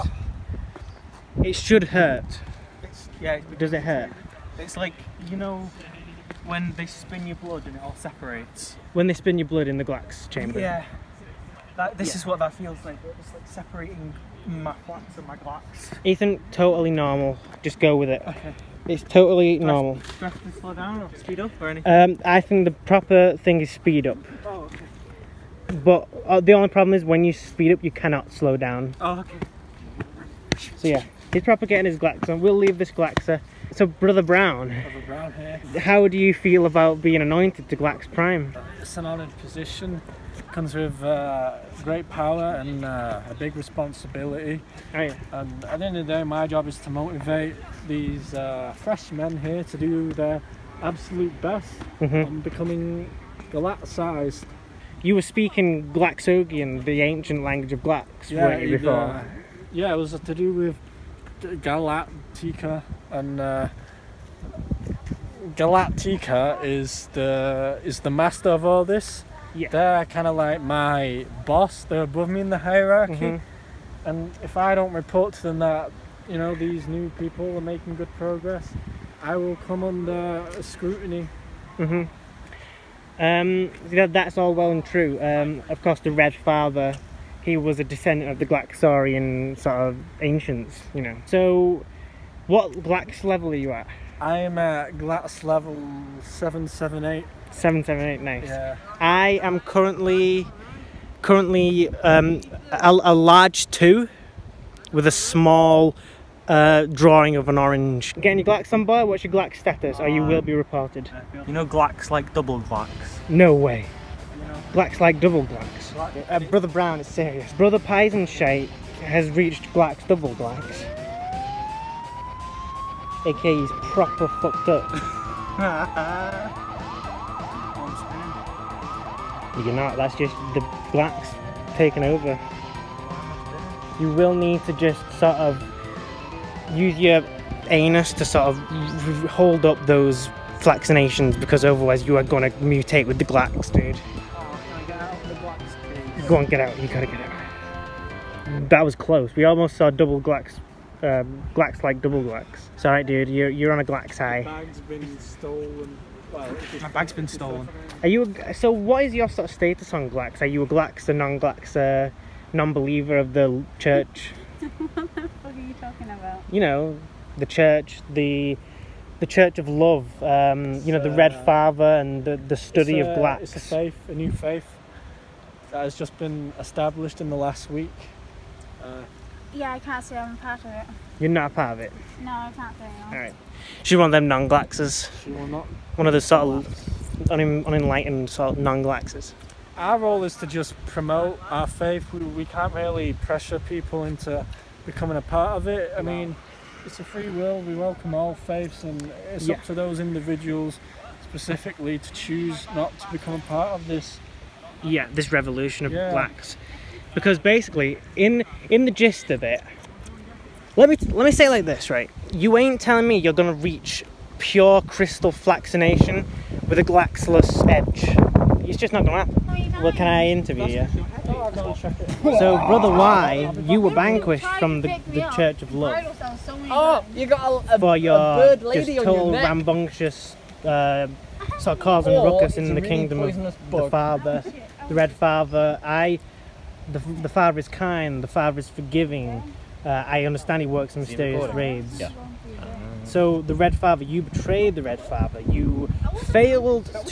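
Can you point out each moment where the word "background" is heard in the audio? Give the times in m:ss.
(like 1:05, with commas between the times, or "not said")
not said.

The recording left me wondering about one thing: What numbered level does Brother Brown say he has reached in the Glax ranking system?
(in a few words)
778.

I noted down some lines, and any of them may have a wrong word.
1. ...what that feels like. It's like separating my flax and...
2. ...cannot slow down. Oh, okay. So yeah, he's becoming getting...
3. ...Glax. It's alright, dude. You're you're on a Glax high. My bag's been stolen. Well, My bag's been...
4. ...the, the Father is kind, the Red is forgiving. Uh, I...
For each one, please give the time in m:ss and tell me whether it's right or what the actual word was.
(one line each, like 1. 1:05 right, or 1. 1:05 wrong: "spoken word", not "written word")
1. 0:12 right
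2. 0:27 wrong: "propagating", not "becoming"
3. 2:32 right
4. 3:56 wrong: "Father", not "Red".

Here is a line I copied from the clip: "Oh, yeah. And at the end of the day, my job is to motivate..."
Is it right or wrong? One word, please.
right.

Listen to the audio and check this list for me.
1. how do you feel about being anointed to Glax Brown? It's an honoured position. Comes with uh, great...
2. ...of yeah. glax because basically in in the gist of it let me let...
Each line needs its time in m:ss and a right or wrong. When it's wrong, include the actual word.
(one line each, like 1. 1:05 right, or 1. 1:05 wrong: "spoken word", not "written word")
1. 0:35 wrong: "Prime", not "Brown"
2. 3:25 right.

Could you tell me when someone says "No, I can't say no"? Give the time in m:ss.
3:02.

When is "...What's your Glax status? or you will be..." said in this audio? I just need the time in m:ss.
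1:49.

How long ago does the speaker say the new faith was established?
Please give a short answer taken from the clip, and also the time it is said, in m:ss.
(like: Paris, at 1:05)
in the last week, at 2:57.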